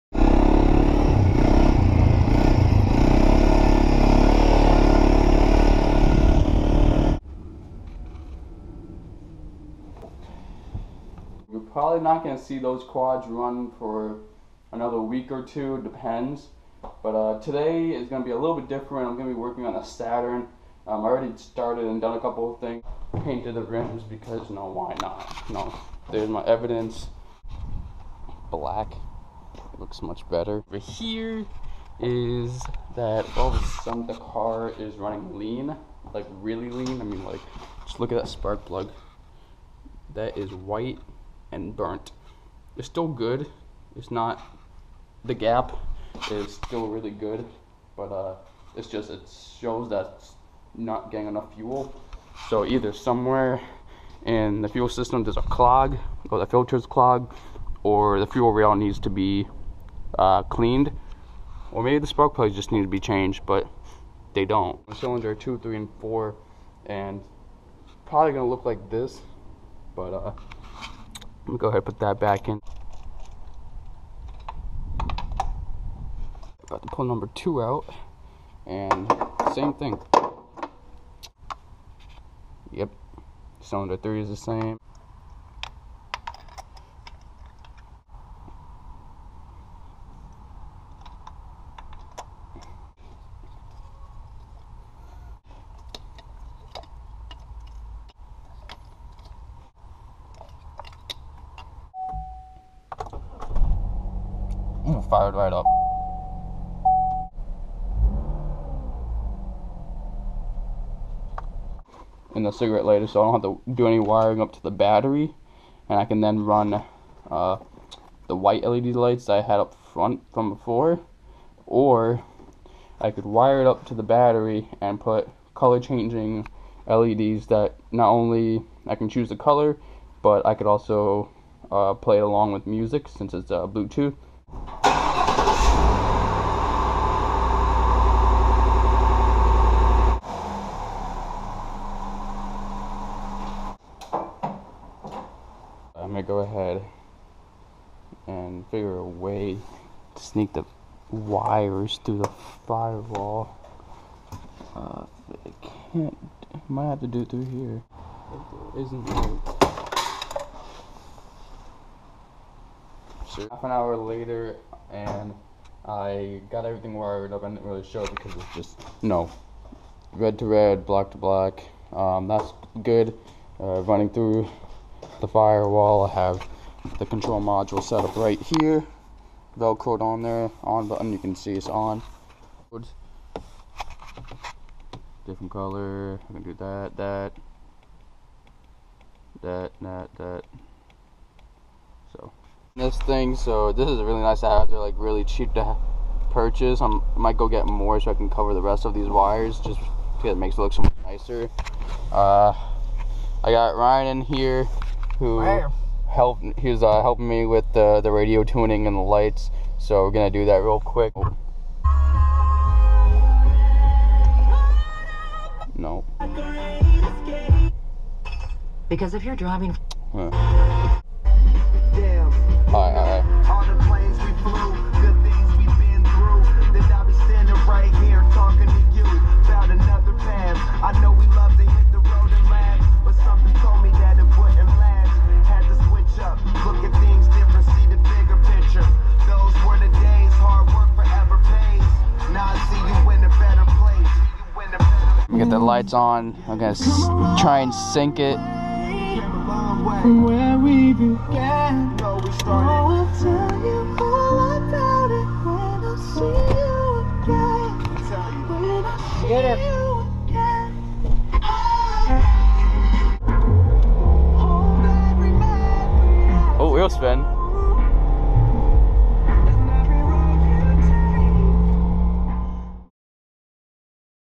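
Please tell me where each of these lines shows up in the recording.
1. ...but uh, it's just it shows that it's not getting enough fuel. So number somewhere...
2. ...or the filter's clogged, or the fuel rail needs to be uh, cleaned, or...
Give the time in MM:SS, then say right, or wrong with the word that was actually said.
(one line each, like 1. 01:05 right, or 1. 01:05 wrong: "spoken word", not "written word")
1. 00:47 wrong: "either", not "number"
2. 00:56 right.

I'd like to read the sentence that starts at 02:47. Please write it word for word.
I didn't really show it because it's just no red to red, black to black.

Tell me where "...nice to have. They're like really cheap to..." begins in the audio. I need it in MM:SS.
03:14.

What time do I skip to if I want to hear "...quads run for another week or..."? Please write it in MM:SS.
00:12.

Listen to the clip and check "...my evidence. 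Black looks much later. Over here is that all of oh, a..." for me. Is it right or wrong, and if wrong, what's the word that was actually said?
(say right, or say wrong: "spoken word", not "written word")
wrong: "better", not "later".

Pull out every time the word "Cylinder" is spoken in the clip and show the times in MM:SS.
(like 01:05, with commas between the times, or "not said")
01:04, 01:23.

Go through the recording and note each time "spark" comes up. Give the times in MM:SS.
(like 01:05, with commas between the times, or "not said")
00:38, 01:02.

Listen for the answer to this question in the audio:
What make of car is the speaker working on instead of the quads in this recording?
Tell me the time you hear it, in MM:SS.
00:19.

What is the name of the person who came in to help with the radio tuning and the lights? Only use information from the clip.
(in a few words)
Ryan.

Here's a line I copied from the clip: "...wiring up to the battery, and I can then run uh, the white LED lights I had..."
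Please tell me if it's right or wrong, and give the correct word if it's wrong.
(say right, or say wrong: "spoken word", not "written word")
right.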